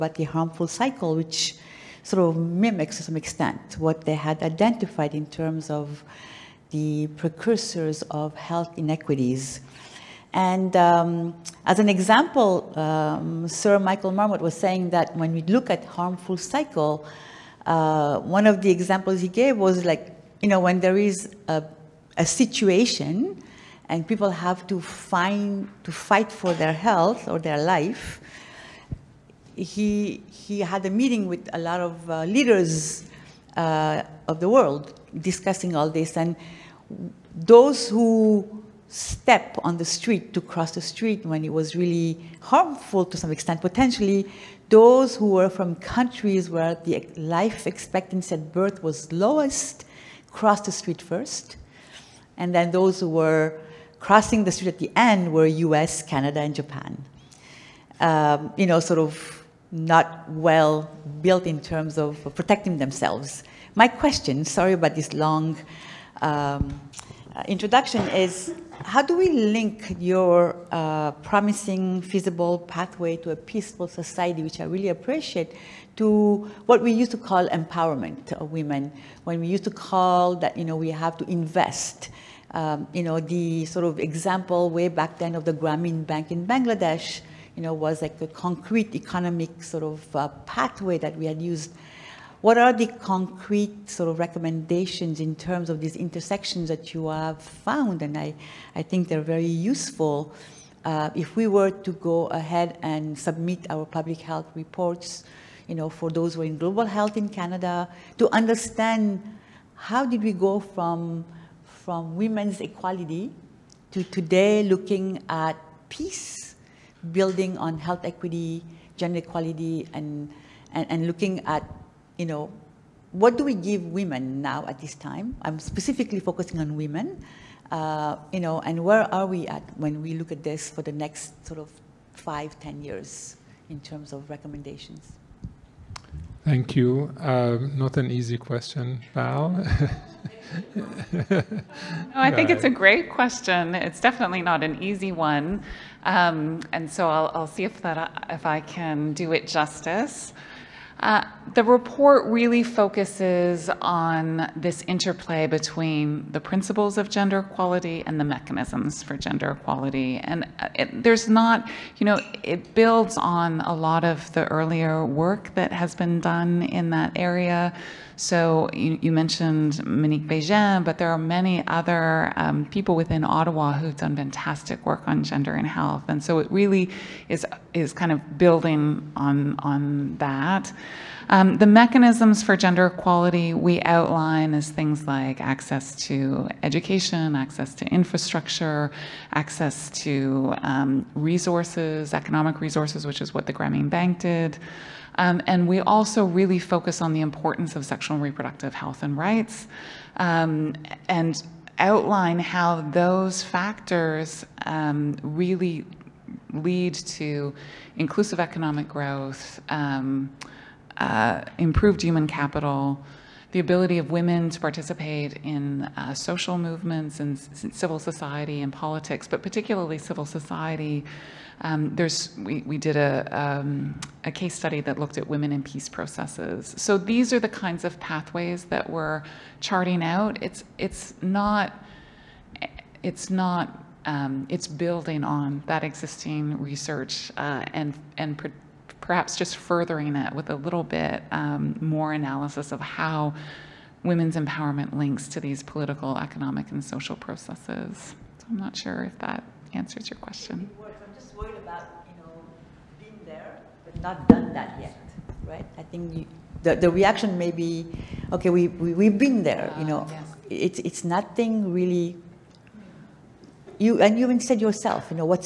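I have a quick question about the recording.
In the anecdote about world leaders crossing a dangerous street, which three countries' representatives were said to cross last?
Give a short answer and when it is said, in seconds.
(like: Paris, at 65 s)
US, Canada, and Japan, at 55 s.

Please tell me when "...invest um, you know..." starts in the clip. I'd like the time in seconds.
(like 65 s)
81 s.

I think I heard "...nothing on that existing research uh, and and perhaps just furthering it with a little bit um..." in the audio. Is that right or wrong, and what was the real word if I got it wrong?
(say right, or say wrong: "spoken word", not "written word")
wrong: "building", not "nothing".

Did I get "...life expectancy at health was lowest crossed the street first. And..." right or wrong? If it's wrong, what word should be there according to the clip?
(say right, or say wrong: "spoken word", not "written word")
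wrong: "birth", not "health".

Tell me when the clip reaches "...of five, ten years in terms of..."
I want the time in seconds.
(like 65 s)
131 s.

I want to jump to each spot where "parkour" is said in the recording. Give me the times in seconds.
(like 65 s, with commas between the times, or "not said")
not said.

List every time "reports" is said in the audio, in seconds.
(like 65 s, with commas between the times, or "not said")
104 s, 151 s.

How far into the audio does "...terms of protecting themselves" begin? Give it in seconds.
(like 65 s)
61 s.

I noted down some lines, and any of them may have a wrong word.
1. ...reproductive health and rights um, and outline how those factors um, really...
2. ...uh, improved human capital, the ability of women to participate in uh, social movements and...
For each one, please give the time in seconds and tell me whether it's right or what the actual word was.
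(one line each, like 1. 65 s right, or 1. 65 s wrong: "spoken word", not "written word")
1. 198 s right
2. 210 s right.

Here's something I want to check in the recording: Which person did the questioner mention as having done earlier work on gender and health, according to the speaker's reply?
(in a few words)
Monique Bégin.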